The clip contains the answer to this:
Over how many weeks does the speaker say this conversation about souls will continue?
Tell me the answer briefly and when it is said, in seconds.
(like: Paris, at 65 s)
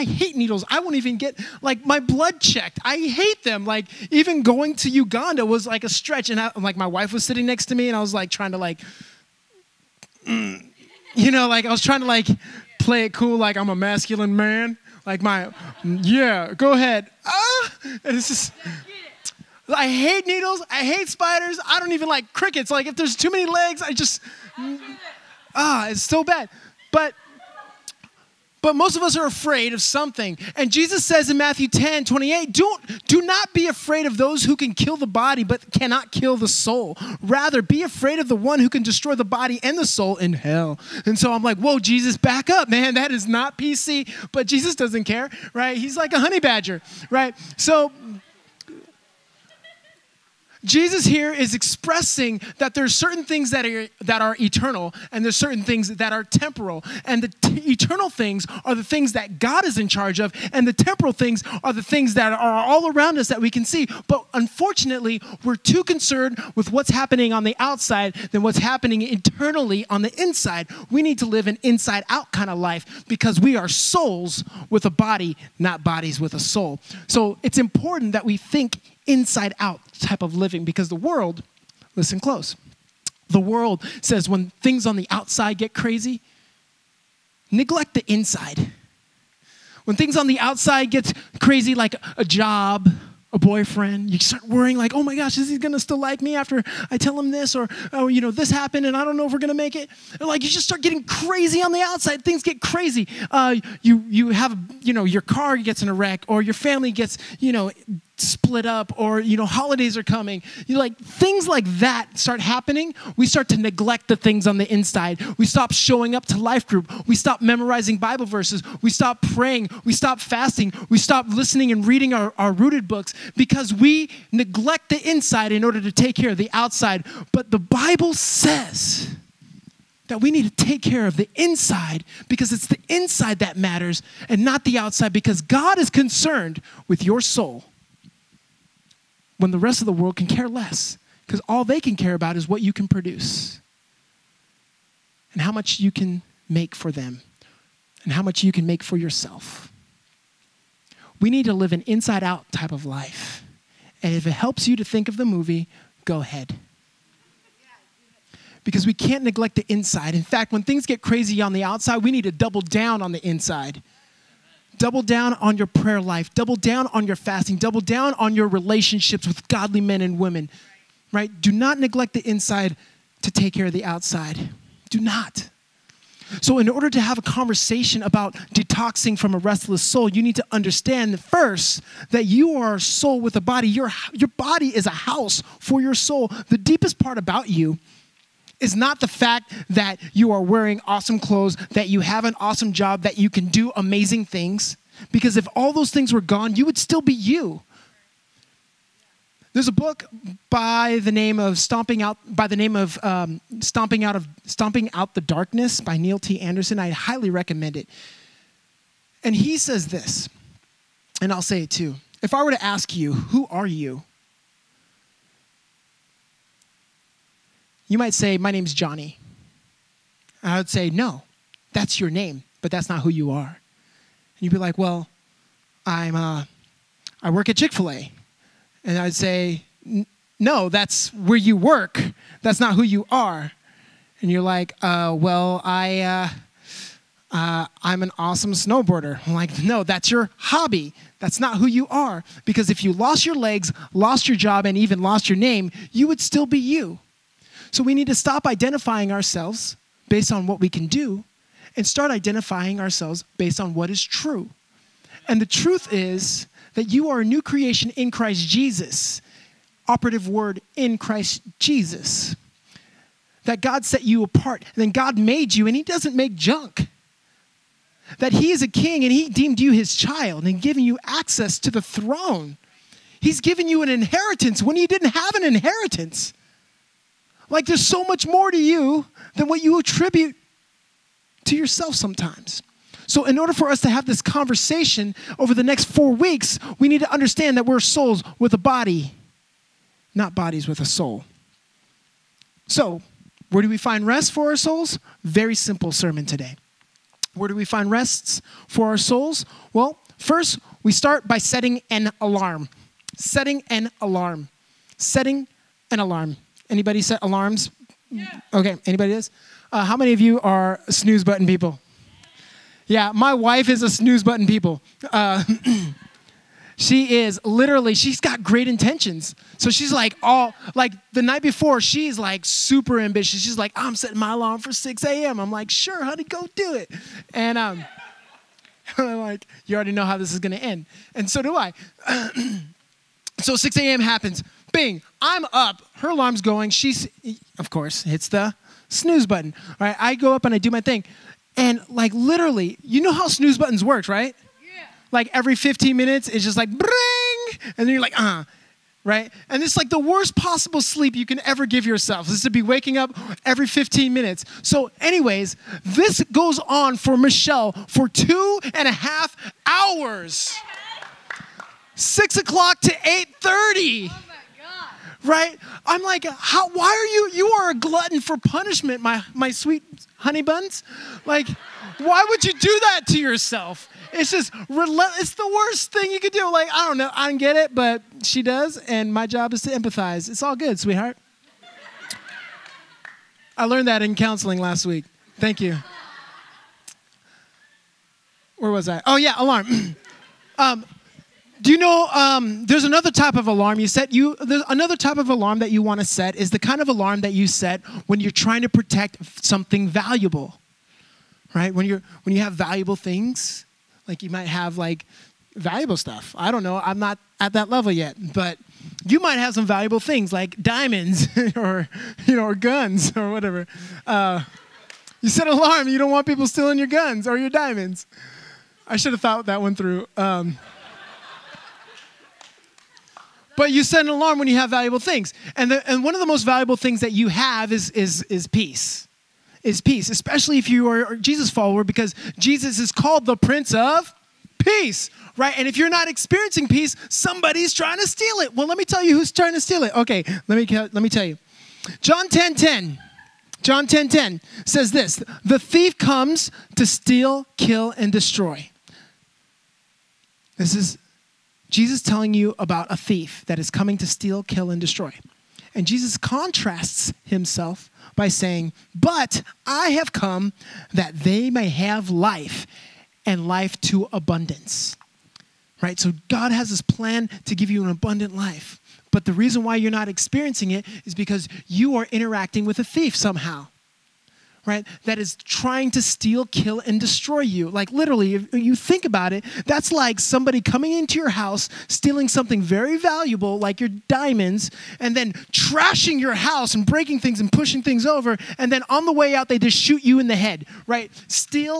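4 weeks, at 285 s.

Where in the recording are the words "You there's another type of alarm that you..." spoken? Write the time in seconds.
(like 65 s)
394 s.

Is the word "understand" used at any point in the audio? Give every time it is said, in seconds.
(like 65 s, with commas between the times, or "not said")
180 s, 287 s.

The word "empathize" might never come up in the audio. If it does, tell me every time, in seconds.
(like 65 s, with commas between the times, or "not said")
379 s.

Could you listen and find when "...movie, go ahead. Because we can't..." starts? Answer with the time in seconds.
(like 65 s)
155 s.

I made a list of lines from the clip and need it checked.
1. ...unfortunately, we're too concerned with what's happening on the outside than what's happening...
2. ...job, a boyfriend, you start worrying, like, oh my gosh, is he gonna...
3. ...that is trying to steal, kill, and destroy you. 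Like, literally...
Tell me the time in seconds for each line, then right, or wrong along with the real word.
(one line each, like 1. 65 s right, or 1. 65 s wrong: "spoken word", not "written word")
1. 64 s right
2. 92 s right
3. 475 s right.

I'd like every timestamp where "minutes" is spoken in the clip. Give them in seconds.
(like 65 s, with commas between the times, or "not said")
345 s, 354 s.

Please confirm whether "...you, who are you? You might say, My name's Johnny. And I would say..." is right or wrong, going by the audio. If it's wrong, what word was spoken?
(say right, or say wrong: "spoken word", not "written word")
right.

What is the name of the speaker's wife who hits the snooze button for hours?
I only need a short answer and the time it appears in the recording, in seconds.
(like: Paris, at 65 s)
Michelle, at 357 s.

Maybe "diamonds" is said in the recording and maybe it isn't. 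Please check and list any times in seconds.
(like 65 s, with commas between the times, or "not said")
410 s, 417 s, 484 s.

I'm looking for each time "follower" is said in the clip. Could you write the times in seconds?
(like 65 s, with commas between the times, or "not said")
431 s.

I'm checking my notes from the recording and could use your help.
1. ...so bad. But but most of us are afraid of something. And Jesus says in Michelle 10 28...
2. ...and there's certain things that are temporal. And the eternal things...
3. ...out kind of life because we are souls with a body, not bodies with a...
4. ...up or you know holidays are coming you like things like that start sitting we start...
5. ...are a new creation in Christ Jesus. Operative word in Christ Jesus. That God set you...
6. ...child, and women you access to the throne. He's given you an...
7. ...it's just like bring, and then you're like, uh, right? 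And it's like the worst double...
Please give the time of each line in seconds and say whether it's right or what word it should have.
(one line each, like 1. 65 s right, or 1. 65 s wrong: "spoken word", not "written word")
1. 26 s wrong: "Matthew", not "Michelle"
2. 55 s right
3. 72 s right
4. 108 s wrong: "happening", not "sitting"
5. 257 s right
6. 269 s wrong: "given", not "women"
7. 346 s wrong: "possible", not "double".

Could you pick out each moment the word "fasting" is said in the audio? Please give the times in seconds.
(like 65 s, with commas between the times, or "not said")
120 s, 167 s.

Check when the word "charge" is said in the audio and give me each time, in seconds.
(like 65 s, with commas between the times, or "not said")
59 s.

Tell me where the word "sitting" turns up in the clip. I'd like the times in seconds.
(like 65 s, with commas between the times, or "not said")
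7 s.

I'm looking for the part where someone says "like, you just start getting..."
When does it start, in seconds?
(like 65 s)
100 s.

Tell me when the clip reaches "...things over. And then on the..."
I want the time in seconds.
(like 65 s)
487 s.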